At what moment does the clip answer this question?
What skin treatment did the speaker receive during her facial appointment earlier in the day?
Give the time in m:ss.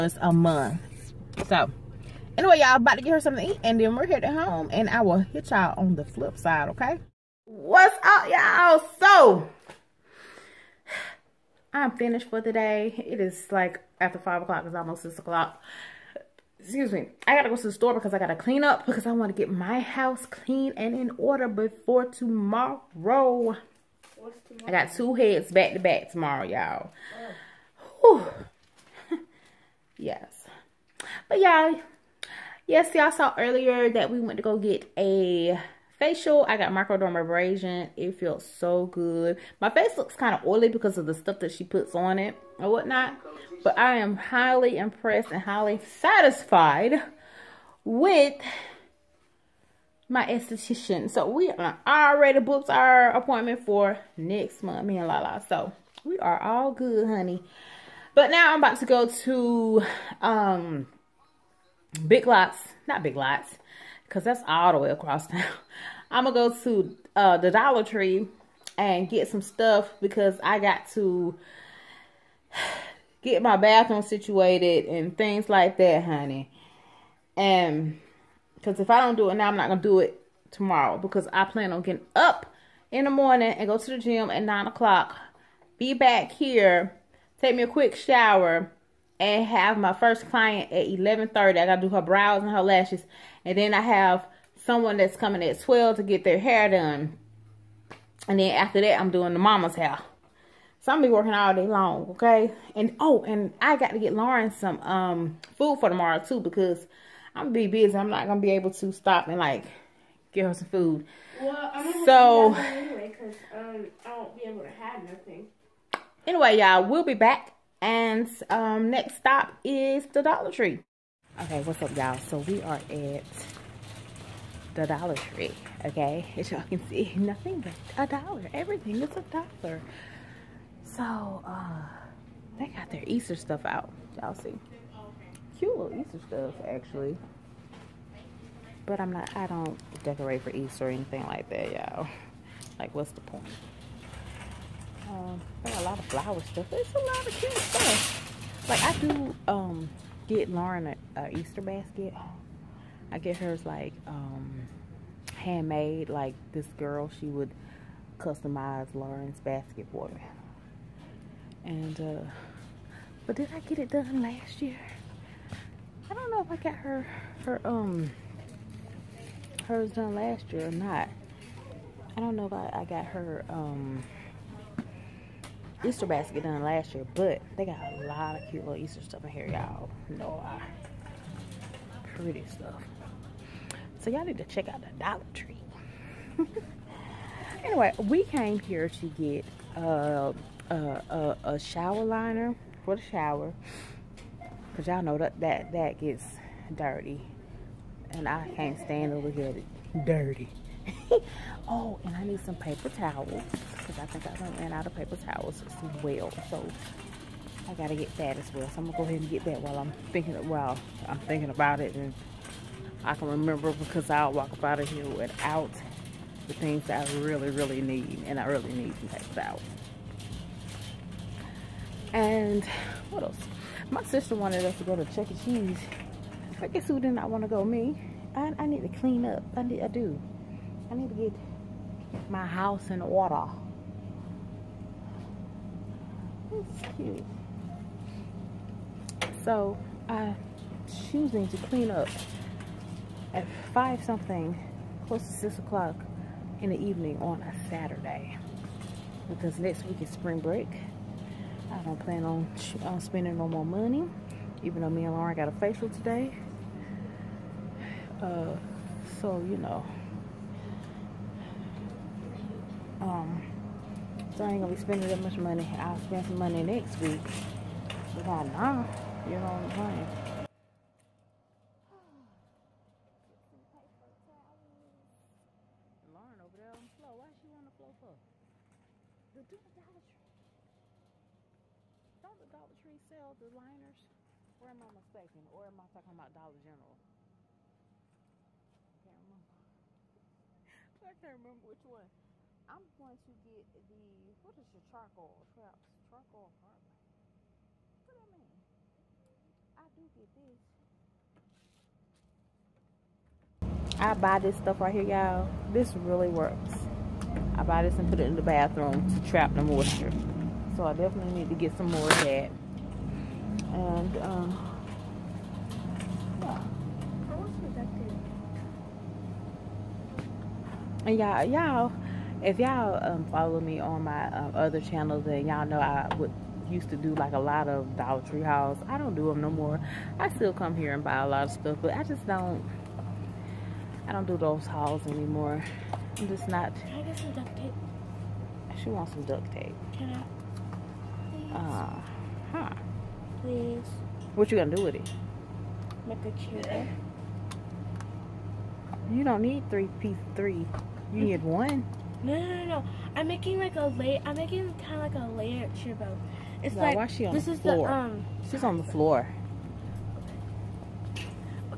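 0:36.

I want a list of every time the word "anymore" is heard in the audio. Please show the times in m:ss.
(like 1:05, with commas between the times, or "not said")
5:35.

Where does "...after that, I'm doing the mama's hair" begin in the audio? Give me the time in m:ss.
1:38.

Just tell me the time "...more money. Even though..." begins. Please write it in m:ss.
4:13.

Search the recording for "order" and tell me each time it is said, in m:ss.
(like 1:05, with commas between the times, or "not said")
0:21, 3:53.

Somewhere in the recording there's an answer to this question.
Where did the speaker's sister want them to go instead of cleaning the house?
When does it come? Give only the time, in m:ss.
3:45.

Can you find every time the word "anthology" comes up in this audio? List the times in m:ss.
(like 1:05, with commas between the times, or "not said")
not said.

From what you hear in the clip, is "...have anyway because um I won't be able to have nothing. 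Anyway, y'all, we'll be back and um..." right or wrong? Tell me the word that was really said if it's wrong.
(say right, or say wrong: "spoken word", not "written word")
right.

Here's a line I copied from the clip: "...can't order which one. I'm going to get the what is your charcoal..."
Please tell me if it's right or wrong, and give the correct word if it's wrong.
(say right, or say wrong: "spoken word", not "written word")
wrong: "remember", not "order".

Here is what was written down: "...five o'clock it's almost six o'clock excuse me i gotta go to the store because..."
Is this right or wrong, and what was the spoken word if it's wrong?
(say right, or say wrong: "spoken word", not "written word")
right.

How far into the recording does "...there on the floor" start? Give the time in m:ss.
4:36.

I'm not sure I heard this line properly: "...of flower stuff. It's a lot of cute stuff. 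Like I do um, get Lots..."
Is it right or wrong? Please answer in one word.
wrong.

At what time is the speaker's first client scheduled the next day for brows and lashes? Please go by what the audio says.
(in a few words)
11:30.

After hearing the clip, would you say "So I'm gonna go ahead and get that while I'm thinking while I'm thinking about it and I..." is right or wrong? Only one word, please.
right.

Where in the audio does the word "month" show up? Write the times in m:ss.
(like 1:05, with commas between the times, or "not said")
0:00, 0:54.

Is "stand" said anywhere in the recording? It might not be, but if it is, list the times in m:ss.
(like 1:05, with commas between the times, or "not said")
3:18.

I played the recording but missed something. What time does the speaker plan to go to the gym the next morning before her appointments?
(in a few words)
9 o'clock.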